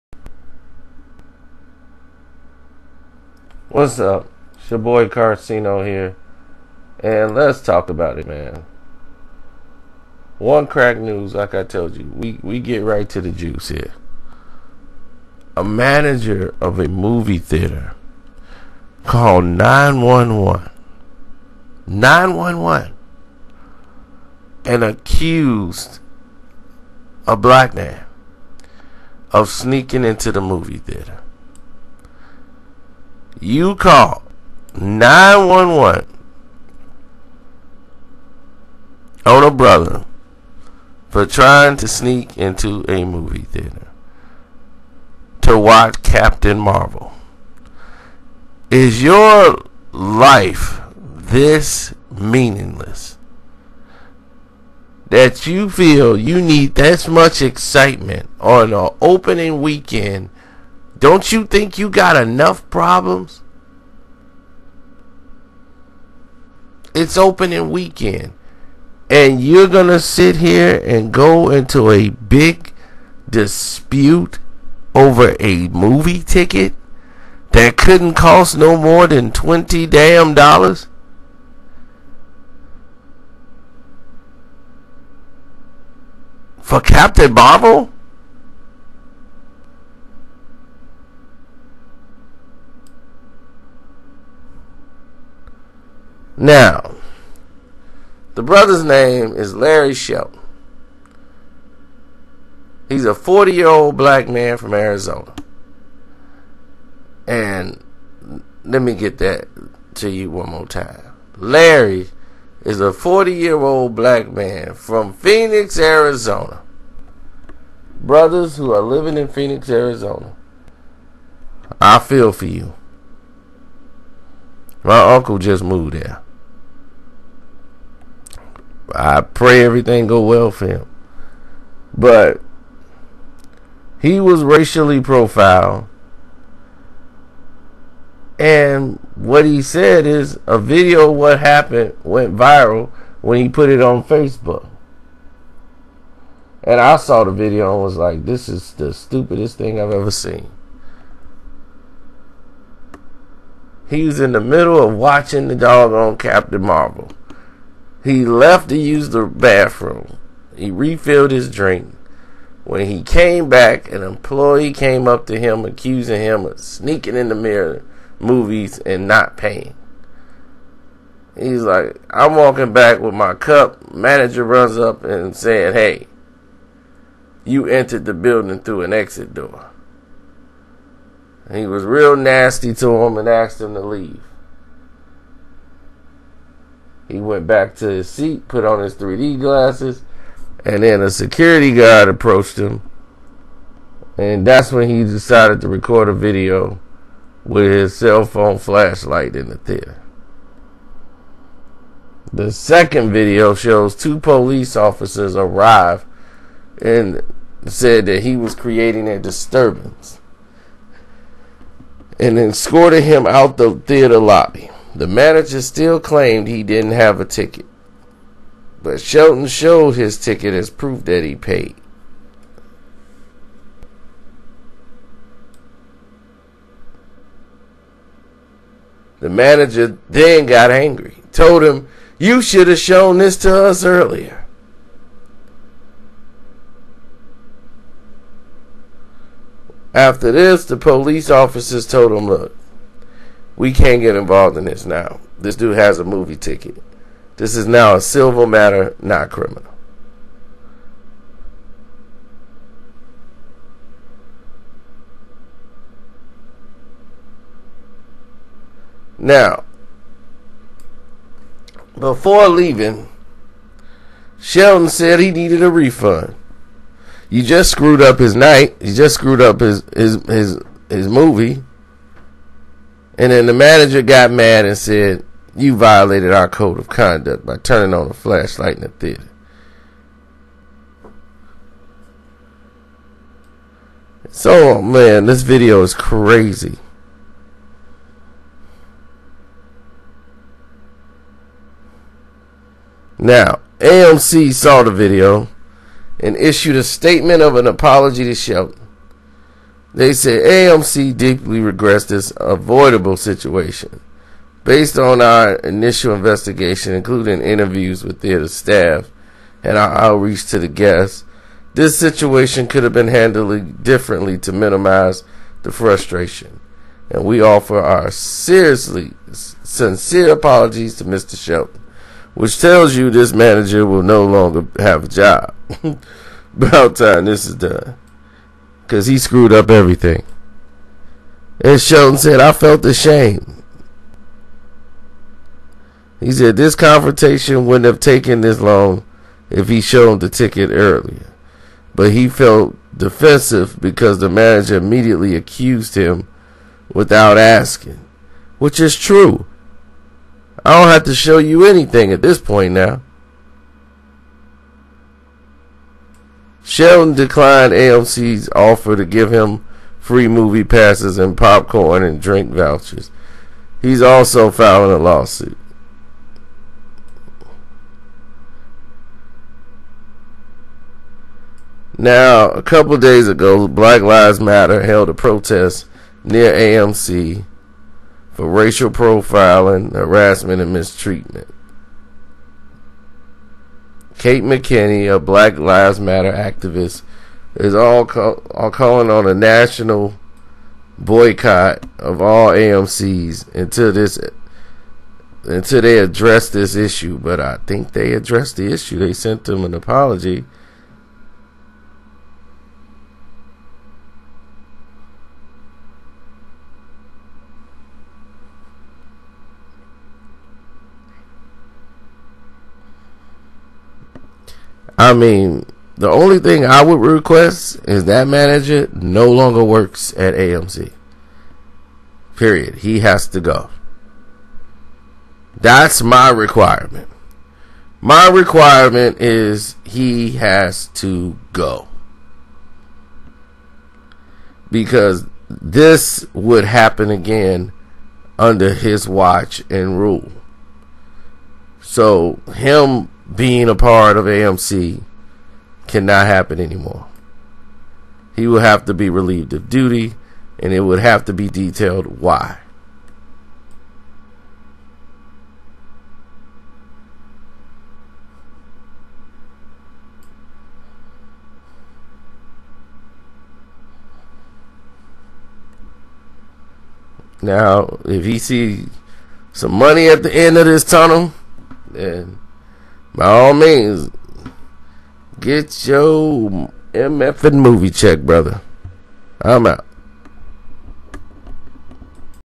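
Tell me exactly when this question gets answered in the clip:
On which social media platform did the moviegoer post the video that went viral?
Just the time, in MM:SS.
02:24.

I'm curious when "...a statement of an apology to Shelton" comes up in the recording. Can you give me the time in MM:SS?
04:56.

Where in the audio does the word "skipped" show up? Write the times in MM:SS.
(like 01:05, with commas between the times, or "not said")
not said.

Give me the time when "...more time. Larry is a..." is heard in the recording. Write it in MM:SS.
01:50.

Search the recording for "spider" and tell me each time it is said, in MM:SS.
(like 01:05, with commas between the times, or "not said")
not said.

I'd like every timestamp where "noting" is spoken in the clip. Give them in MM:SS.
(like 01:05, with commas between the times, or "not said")
not said.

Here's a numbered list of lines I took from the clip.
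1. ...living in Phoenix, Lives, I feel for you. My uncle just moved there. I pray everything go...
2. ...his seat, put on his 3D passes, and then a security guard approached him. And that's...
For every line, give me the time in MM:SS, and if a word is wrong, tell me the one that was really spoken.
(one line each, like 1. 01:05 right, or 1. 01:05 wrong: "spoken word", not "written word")
1. 01:58 wrong: "Arizona", not "Lives"
2. 03:07 wrong: "glasses", not "passes".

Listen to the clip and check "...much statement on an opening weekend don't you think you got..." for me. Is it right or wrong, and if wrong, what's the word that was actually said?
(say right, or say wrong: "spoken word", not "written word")
wrong: "excitement", not "statement".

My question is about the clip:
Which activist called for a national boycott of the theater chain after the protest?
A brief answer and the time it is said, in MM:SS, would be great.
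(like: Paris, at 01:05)
Kate McKinney, at 06:24.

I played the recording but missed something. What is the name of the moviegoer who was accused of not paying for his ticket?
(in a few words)
Larry Shelton.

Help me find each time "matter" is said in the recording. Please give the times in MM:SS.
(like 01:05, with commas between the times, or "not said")
04:08, 06:14, 06:25.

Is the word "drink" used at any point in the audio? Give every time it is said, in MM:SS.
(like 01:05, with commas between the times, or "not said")
02:41, 06:02.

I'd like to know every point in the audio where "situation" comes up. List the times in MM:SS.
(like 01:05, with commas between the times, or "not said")
05:03, 05:11.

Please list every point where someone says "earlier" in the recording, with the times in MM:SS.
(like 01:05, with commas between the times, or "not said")
03:53, 05:40.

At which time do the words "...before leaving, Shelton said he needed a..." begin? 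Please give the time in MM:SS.
04:21.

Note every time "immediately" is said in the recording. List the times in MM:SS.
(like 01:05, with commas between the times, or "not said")
05:44.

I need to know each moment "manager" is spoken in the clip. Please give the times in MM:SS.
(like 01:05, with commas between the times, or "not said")
00:15, 02:53, 03:35, 03:49, 04:33, 05:23, 05:44, 06:58.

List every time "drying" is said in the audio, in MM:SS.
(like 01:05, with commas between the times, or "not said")
not said.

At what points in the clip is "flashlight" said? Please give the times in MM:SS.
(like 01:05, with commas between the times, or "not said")
03:18, 04:38.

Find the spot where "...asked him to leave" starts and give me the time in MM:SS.
03:03.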